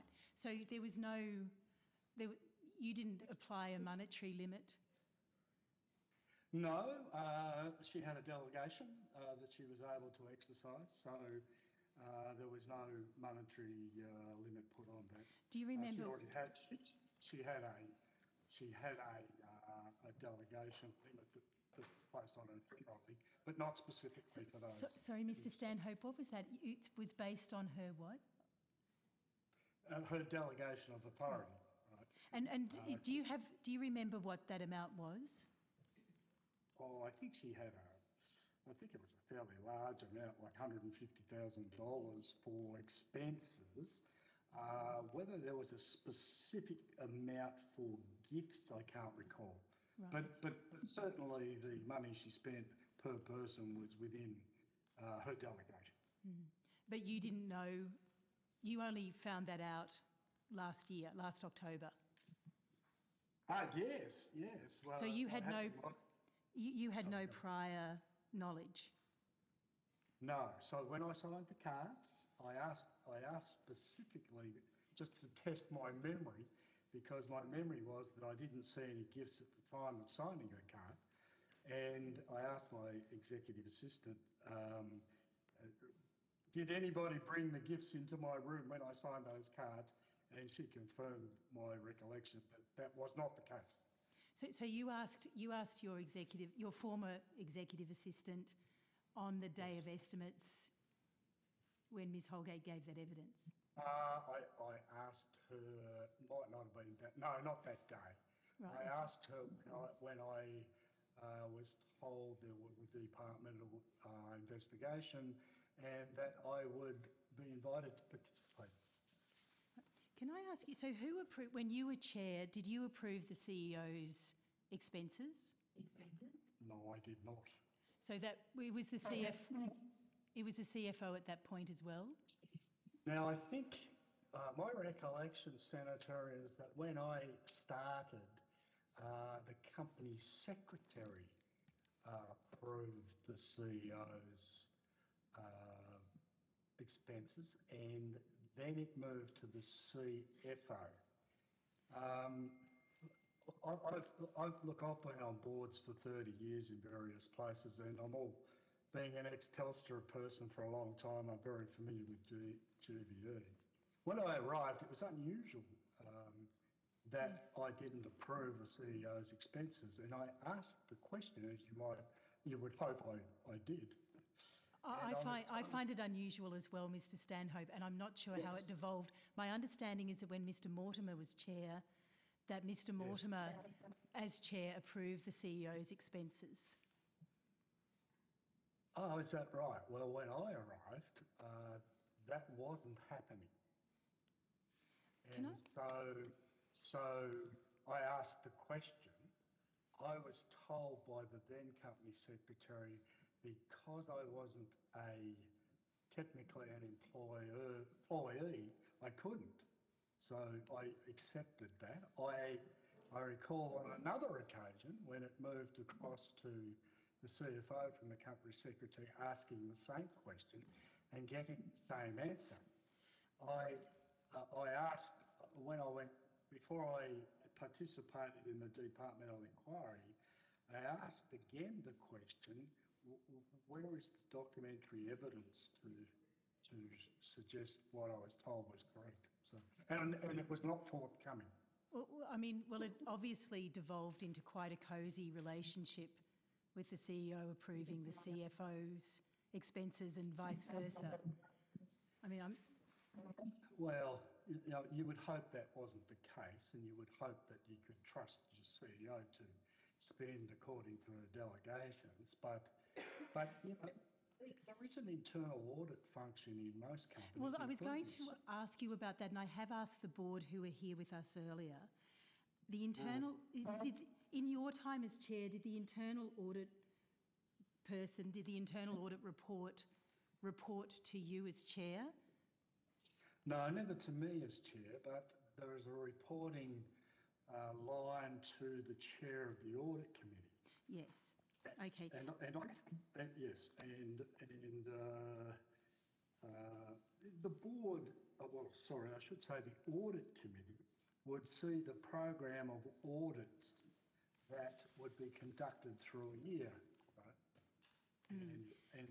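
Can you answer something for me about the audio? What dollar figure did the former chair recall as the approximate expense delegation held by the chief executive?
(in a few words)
$150,000.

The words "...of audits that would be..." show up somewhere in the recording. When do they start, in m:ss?
5:02.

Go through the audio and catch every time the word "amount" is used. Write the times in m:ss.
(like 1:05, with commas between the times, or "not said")
0:34, 0:40, 0:46.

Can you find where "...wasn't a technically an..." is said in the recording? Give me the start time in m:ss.
3:24.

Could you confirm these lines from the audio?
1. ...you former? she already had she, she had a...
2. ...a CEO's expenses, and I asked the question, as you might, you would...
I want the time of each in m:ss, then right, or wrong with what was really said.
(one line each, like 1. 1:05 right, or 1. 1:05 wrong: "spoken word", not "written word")
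1. 0:15 wrong: "remember", not "former"
2. 2:48 right.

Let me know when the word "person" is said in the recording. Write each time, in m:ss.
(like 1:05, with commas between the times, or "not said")
0:53, 2:40, 4:37.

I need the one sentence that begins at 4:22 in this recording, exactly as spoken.
But, but you know, there is an internal audit function in most companies.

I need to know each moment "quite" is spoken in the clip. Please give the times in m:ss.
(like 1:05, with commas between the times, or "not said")
4:04.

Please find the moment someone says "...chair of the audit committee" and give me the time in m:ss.
4:48.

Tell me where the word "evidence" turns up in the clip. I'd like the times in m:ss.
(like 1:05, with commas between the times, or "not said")
1:42, 3:55.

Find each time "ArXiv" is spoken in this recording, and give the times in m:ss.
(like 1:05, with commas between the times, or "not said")
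not said.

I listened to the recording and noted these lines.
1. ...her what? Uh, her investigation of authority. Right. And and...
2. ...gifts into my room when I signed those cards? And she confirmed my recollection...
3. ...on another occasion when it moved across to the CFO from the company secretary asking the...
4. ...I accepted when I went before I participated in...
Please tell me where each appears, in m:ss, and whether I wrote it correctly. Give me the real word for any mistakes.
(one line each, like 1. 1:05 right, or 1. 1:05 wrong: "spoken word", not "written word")
1. 0:27 wrong: "delegation", not "investigation"
2. 1:27 right
3. 3:33 right
4. 3:44 wrong: "asked", not "accepted".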